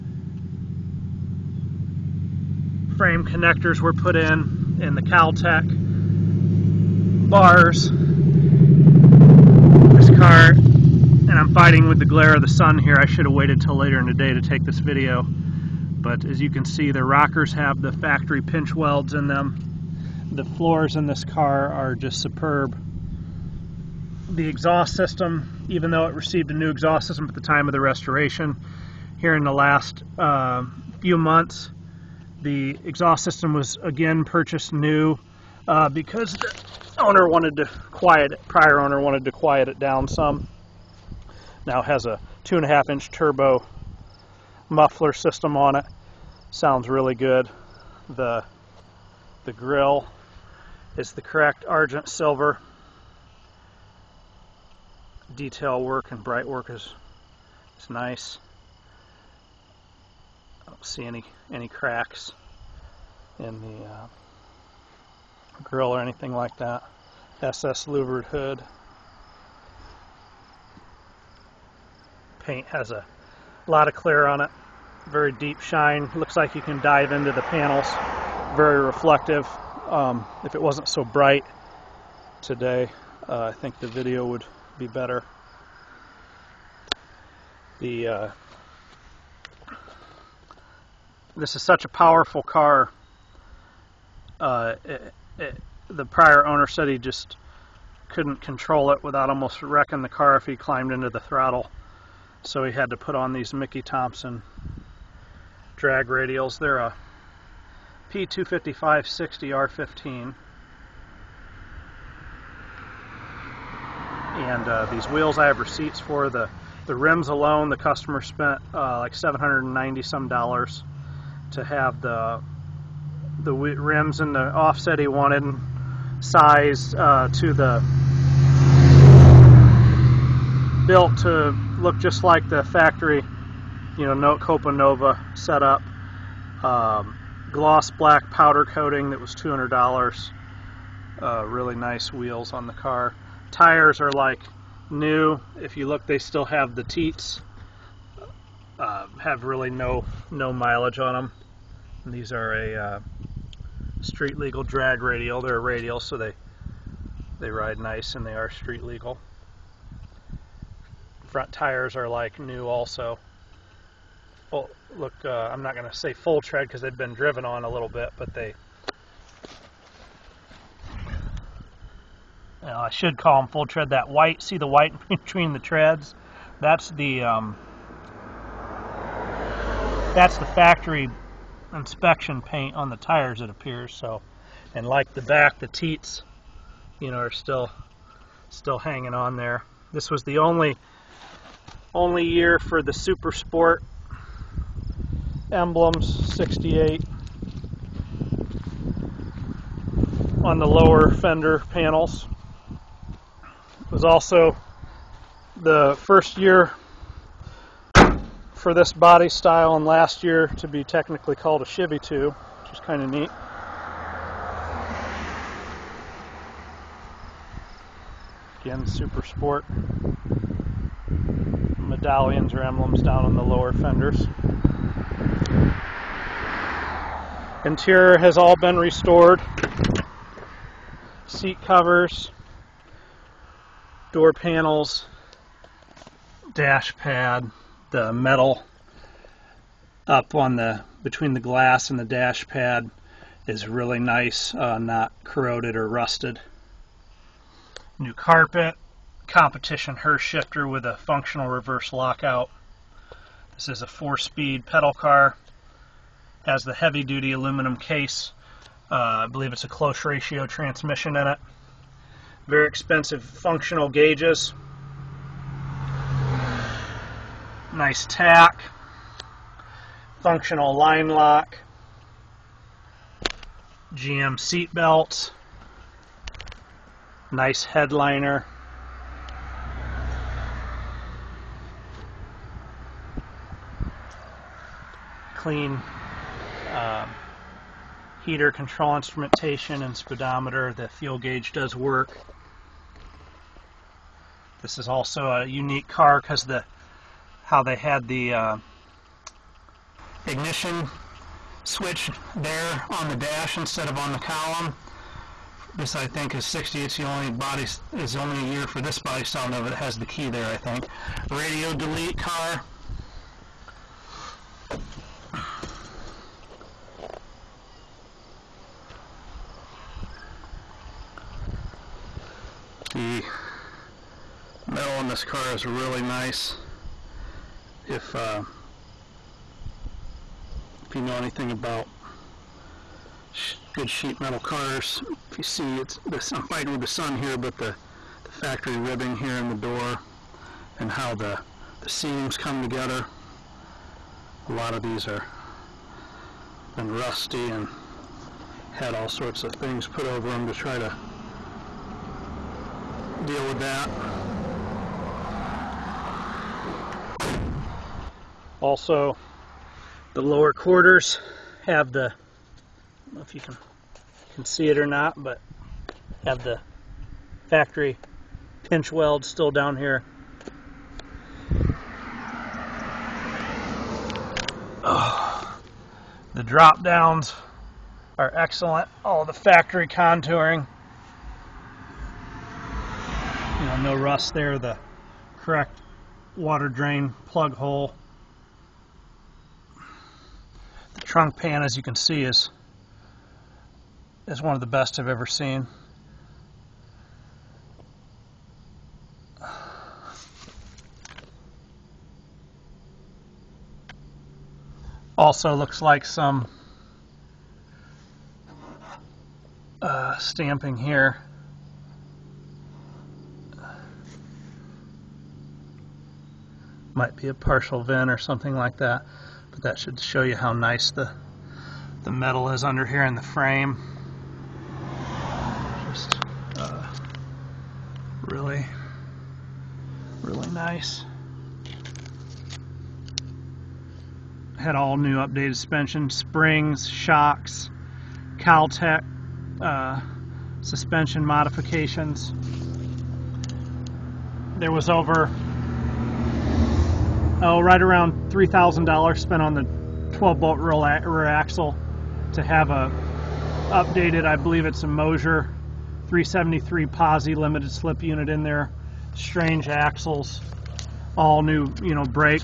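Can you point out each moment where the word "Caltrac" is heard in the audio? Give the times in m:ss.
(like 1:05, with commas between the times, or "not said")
0:05, 7:18.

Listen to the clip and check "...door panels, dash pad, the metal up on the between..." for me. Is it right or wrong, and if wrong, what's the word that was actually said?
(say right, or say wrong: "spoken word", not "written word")
right.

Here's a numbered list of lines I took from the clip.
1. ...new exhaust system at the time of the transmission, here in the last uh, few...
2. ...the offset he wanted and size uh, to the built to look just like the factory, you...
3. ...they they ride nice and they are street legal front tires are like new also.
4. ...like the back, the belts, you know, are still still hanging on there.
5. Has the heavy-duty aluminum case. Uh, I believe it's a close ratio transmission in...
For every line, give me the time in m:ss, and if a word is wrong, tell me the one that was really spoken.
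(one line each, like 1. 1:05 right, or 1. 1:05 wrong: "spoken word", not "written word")
1. 0:26 wrong: "restoration", not "transmission"
2. 2:04 right
3. 2:36 right
4. 3:04 wrong: "teats", not "belts"
5. 4:16 right.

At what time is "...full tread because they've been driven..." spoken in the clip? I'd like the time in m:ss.
2:46.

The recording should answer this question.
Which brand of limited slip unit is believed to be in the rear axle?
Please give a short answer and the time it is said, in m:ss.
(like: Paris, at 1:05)
Moser, at 7:34.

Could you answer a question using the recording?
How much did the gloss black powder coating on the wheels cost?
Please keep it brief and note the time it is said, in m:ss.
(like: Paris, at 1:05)
$200, at 2:19.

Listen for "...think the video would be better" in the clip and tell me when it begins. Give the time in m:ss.
1:23.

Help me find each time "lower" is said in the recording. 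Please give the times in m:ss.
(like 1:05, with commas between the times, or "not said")
3:20, 3:43, 6:00.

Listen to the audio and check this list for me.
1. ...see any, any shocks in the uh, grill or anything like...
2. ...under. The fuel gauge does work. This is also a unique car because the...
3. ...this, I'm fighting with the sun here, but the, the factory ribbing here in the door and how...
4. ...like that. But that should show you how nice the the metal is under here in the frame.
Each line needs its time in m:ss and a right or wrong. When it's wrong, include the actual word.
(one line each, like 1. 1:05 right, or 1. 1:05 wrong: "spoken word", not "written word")
1. 1:00 wrong: "cracks", not "shocks"
2. 4:49 wrong: "speedometer", not "under"
3. 5:36 right
4. 6:58 right.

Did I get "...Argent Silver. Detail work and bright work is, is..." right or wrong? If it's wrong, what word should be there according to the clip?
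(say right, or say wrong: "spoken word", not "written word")
right.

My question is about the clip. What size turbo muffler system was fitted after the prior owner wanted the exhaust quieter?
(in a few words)
2.5 inch.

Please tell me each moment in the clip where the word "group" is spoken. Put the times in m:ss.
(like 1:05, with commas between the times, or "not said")
not said.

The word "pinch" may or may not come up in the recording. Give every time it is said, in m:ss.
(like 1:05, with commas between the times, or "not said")
0:18, 6:08.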